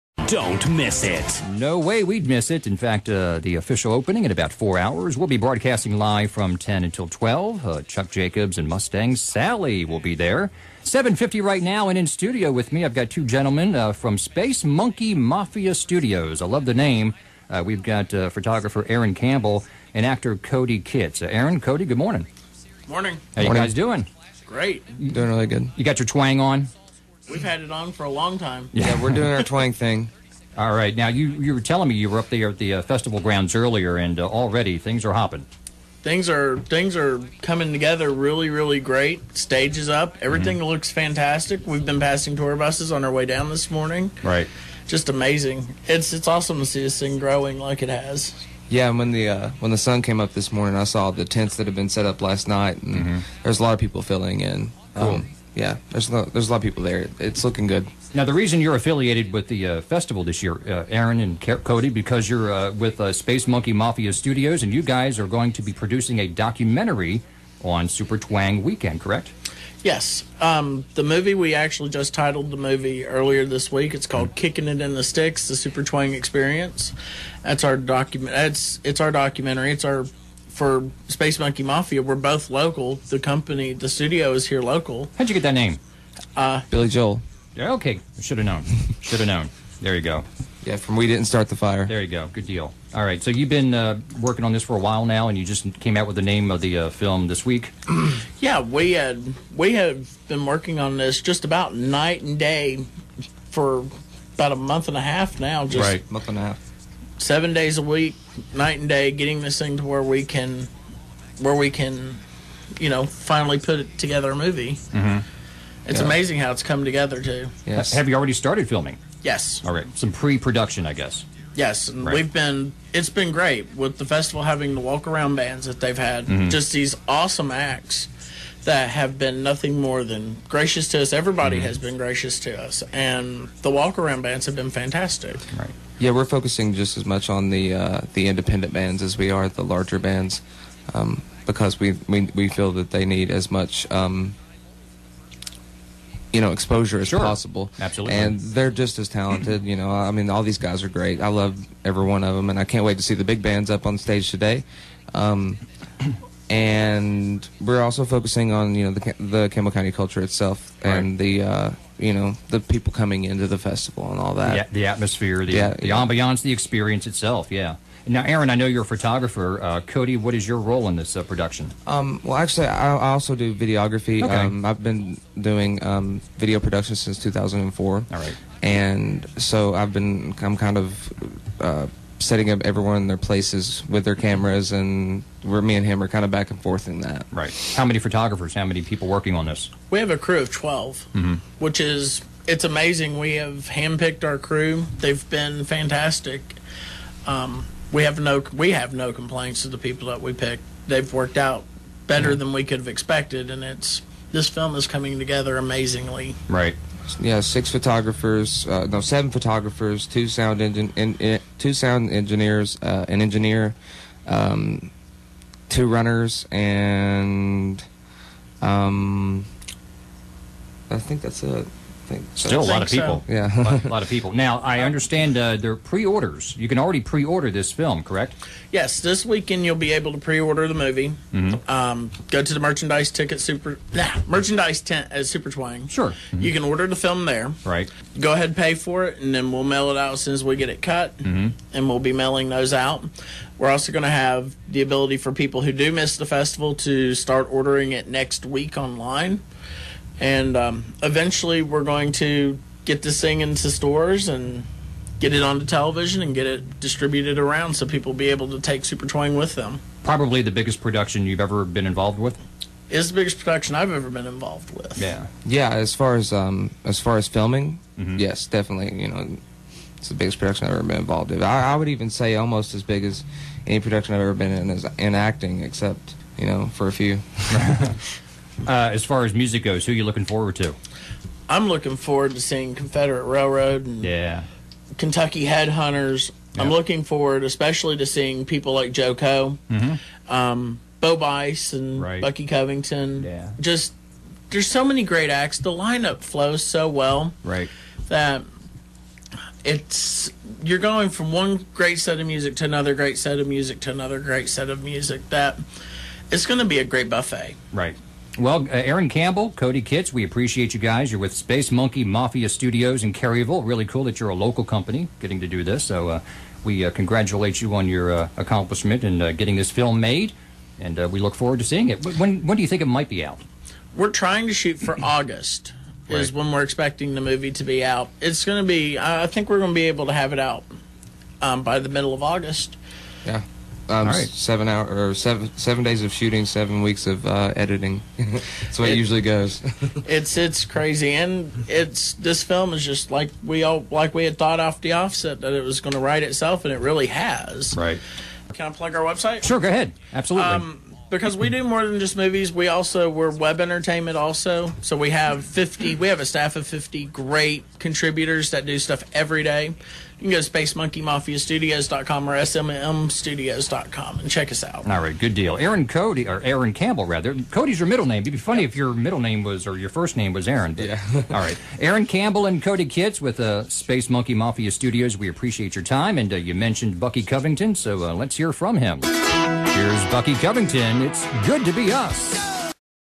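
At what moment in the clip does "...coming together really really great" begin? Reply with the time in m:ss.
0:37.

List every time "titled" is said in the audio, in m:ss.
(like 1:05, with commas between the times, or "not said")
1:12.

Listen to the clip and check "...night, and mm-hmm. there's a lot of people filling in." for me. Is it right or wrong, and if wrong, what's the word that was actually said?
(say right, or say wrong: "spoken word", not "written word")
right.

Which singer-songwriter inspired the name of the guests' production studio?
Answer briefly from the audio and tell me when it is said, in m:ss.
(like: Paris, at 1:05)
Billy Joel, at 1:26.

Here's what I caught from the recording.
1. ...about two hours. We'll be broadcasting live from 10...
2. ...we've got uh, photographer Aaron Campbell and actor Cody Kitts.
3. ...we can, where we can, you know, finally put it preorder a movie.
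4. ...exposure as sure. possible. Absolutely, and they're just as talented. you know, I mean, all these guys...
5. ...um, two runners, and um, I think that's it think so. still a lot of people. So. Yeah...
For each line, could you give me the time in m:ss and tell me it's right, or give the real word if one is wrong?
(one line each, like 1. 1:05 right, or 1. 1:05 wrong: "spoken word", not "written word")
1. 0:04 wrong: "four", not "two"
2. 0:17 right
3. 1:50 wrong: "together", not "preorder"
4. 2:26 right
5. 3:34 right.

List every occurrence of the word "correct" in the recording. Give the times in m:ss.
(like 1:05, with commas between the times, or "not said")
1:08, 3:48.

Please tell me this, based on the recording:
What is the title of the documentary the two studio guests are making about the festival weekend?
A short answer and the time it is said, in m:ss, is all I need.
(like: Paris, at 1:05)
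Kicking It in the Sticks, at 1:14.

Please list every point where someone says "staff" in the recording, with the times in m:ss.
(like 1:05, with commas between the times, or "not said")
5:56.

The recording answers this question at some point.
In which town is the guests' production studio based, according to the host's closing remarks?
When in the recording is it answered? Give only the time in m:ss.
5:13.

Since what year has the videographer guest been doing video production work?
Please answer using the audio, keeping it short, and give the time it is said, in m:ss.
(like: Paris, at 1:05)
2004, at 2:57.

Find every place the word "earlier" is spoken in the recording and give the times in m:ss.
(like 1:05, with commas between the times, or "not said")
0:33, 1:13.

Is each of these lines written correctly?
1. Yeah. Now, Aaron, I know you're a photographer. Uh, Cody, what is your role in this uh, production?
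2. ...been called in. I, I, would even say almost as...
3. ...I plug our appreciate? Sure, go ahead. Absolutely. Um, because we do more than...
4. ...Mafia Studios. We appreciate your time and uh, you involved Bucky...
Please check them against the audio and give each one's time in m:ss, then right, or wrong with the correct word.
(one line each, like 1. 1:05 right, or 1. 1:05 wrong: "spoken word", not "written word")
1. 2:47 right
2. 4:30 wrong: "involved", not "called"
3. 5:48 wrong: "website", not "appreciate"
4. 6:14 wrong: "mentioned", not "involved".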